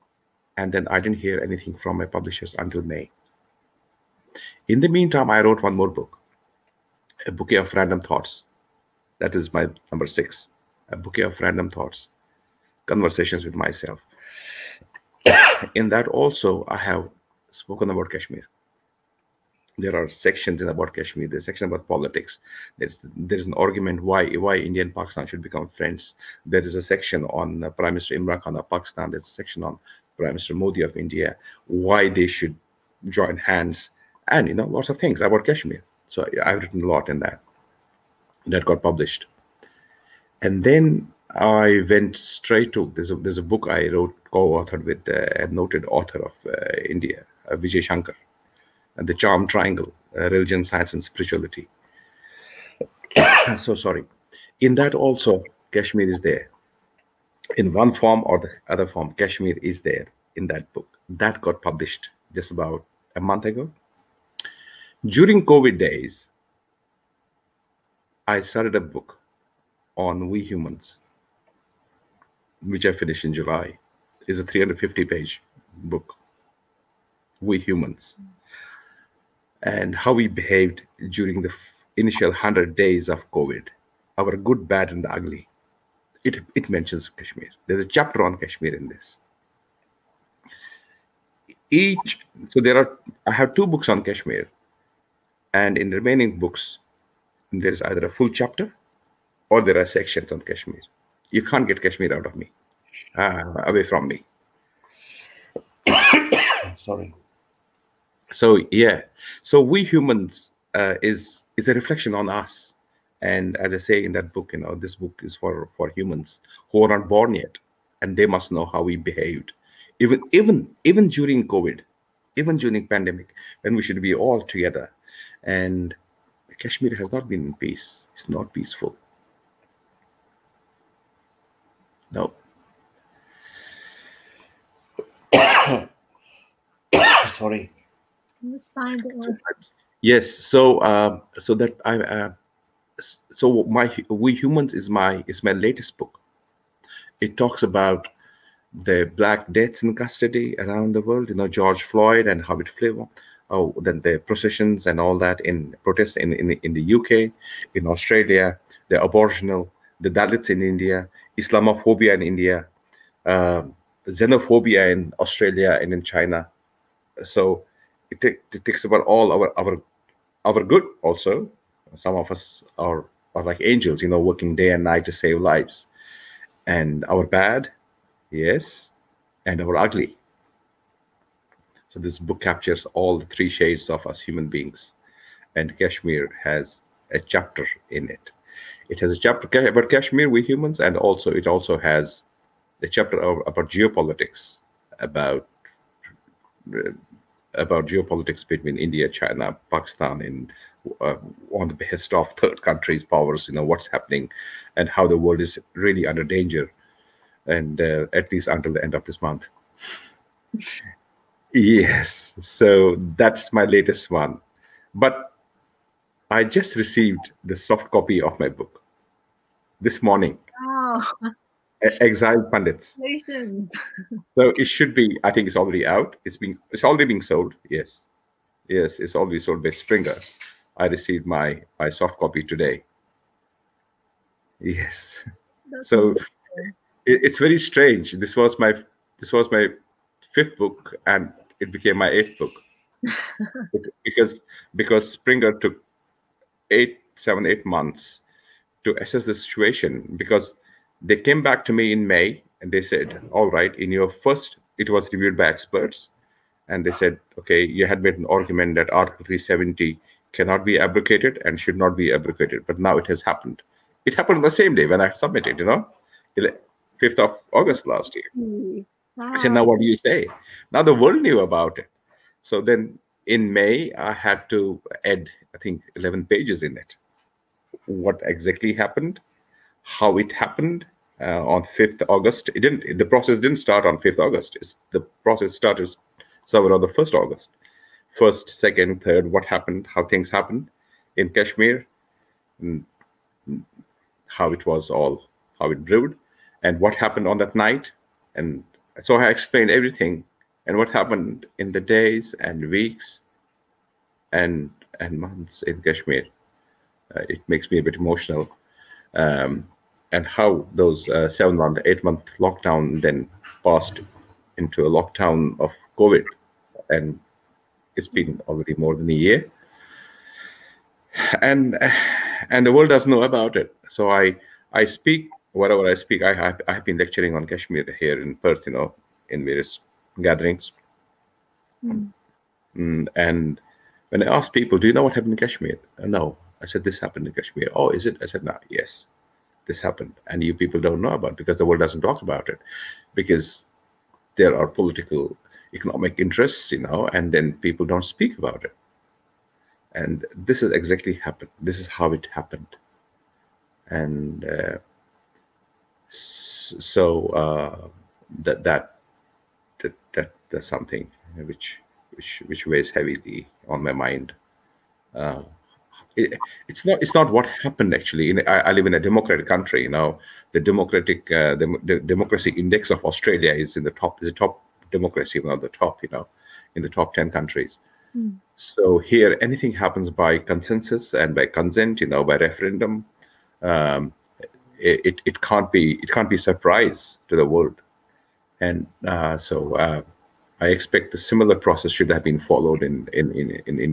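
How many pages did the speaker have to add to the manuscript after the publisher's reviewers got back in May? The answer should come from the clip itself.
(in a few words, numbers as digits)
11.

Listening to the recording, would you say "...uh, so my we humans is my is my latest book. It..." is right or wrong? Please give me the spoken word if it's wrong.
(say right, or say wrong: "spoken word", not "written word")
right.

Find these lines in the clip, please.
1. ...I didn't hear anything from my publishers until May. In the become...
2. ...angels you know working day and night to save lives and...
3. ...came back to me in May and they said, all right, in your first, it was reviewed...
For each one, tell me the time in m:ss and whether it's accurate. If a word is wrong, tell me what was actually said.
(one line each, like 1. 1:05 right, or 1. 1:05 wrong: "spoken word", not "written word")
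1. 0:00 wrong: "meantime", not "become"
2. 2:53 right
3. 4:11 right.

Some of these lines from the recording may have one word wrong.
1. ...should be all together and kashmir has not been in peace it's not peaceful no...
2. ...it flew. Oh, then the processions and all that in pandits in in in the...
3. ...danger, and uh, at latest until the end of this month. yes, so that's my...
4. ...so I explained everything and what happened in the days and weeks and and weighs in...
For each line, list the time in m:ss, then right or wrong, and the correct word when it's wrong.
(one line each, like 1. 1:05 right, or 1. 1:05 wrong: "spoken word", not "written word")
1. 2:03 right
2. 2:32 wrong: "protests", not "pandits"
3. 3:26 wrong: "least", not "latest"
4. 4:59 wrong: "months", not "weighs".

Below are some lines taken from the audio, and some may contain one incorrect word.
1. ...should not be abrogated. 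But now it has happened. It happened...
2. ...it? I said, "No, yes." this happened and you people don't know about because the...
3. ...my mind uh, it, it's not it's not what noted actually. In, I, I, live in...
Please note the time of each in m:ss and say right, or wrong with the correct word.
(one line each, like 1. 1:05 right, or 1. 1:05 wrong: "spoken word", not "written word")
1. 4:21 right
2. 5:38 right
3. 6:03 wrong: "happened", not "noted".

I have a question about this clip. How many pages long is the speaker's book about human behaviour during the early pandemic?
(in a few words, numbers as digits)
350.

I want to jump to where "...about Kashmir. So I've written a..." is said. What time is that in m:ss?
0:35.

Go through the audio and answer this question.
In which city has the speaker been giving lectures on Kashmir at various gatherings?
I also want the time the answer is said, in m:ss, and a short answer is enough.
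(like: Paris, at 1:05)
Perth, at 5:27.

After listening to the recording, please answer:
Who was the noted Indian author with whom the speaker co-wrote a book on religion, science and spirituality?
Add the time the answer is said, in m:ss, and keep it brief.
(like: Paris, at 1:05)
Vijay Shankar, at 0:47.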